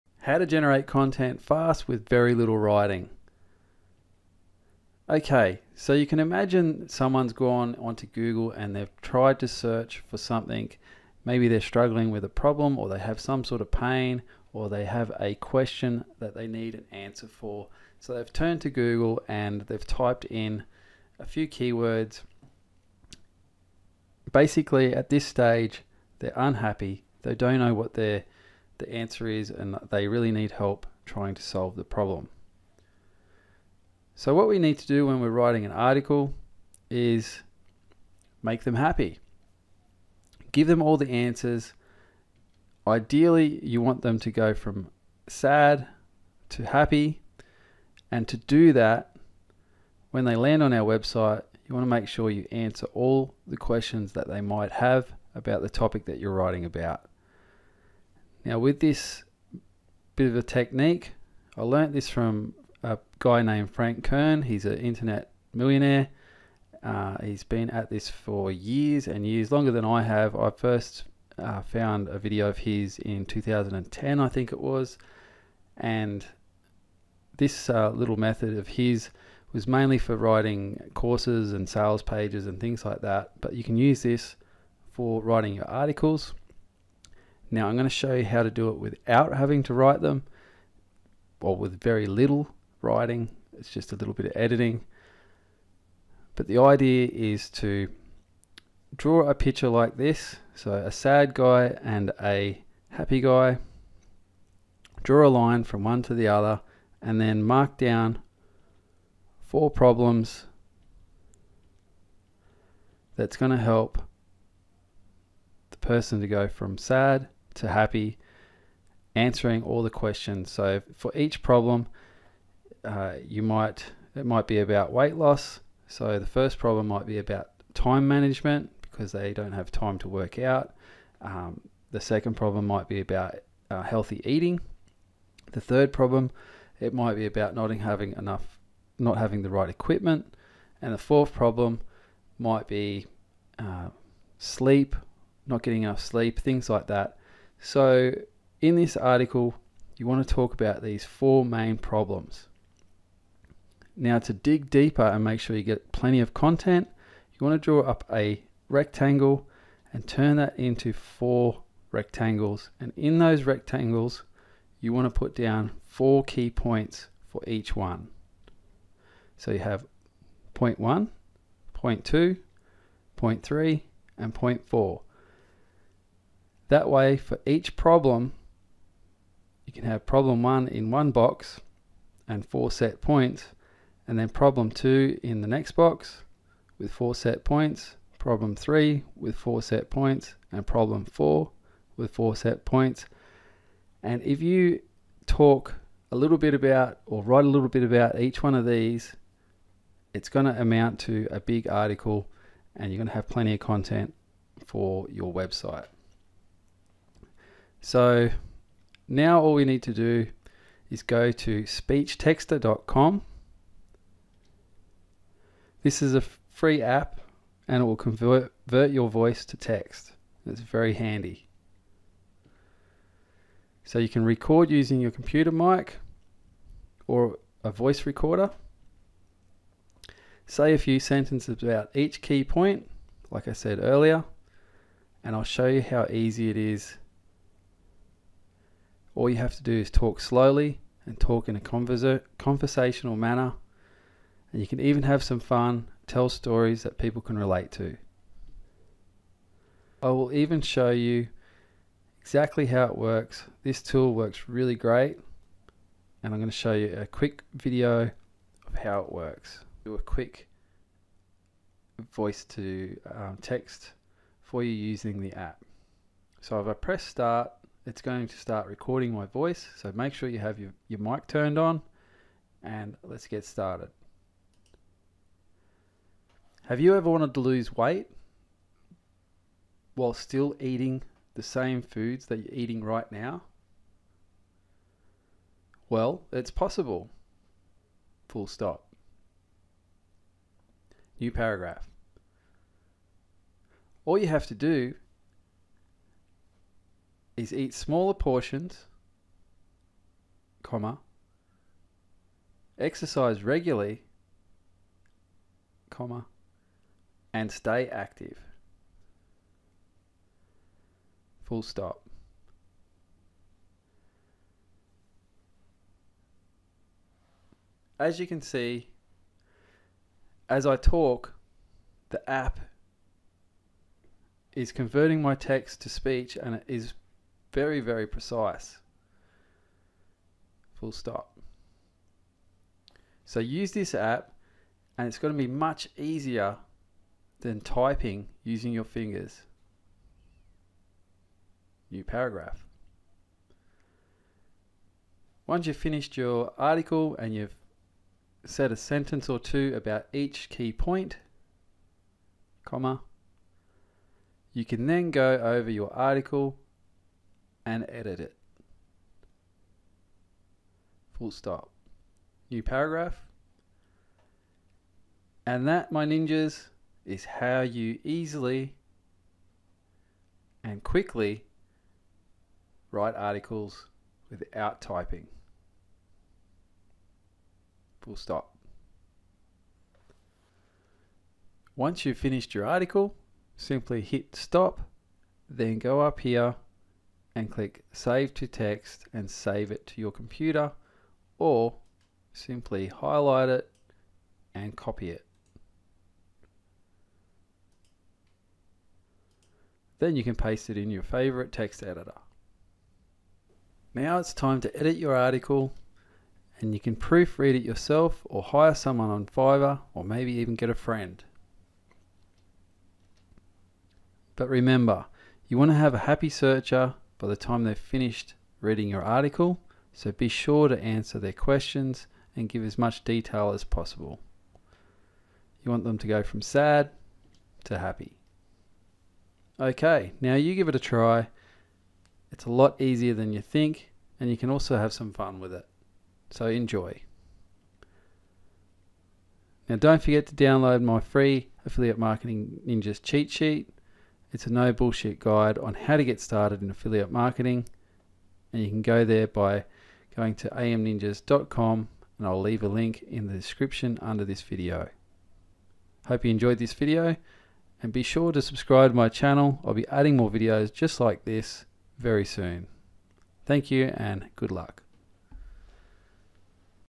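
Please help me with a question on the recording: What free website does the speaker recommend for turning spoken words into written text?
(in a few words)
speechtexter.com.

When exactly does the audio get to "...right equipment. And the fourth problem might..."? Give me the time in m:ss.
2:19.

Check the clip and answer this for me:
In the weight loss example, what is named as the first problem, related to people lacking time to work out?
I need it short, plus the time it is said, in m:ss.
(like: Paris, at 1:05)
Time management, at 2:07.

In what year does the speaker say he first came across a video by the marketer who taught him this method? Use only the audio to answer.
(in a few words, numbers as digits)
2010.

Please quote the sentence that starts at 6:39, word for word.
Then you can paste it in your favorite text editor.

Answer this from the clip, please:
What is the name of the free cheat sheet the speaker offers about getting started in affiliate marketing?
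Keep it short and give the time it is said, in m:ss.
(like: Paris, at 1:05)
Affiliate Marketing Ninjas, at 7:21.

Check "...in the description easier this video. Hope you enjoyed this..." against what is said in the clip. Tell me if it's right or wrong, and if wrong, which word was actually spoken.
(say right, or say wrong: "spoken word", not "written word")
wrong: "under", not "easier".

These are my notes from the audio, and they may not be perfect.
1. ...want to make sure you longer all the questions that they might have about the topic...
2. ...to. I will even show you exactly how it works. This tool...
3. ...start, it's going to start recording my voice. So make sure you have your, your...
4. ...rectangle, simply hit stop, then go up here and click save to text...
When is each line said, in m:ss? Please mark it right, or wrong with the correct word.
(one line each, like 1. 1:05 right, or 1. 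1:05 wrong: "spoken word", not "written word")
1. 0:51 wrong: "answer", not "longer"
2. 4:07 right
3. 4:27 right
4. 6:22 wrong: "article", not "rectangle".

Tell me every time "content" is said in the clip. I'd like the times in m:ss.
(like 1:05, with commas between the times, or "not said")
0:00, 2:36, 3:23.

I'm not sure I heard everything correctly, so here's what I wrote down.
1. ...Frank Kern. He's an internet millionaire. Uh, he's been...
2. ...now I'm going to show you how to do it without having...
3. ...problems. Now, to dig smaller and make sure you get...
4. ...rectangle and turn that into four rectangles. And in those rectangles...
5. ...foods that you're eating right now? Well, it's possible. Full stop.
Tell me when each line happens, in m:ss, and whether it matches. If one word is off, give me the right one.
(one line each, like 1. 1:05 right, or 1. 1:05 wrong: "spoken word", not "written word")
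1. 1:03 right
2. 1:27 right
3. 2:31 wrong: "deeper", not "smaller"
4. 2:38 right
5. 4:41 right.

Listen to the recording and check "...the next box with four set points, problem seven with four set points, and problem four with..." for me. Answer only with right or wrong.
wrong.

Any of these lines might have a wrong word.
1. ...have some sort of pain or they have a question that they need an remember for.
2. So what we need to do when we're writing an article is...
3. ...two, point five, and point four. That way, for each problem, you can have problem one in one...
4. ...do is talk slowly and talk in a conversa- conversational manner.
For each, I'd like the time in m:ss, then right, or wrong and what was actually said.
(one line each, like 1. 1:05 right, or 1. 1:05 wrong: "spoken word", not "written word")
1. 0:12 wrong: "answer", not "remember"
2. 0:34 right
3. 2:52 wrong: "three", not "five"
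4. 3:59 right.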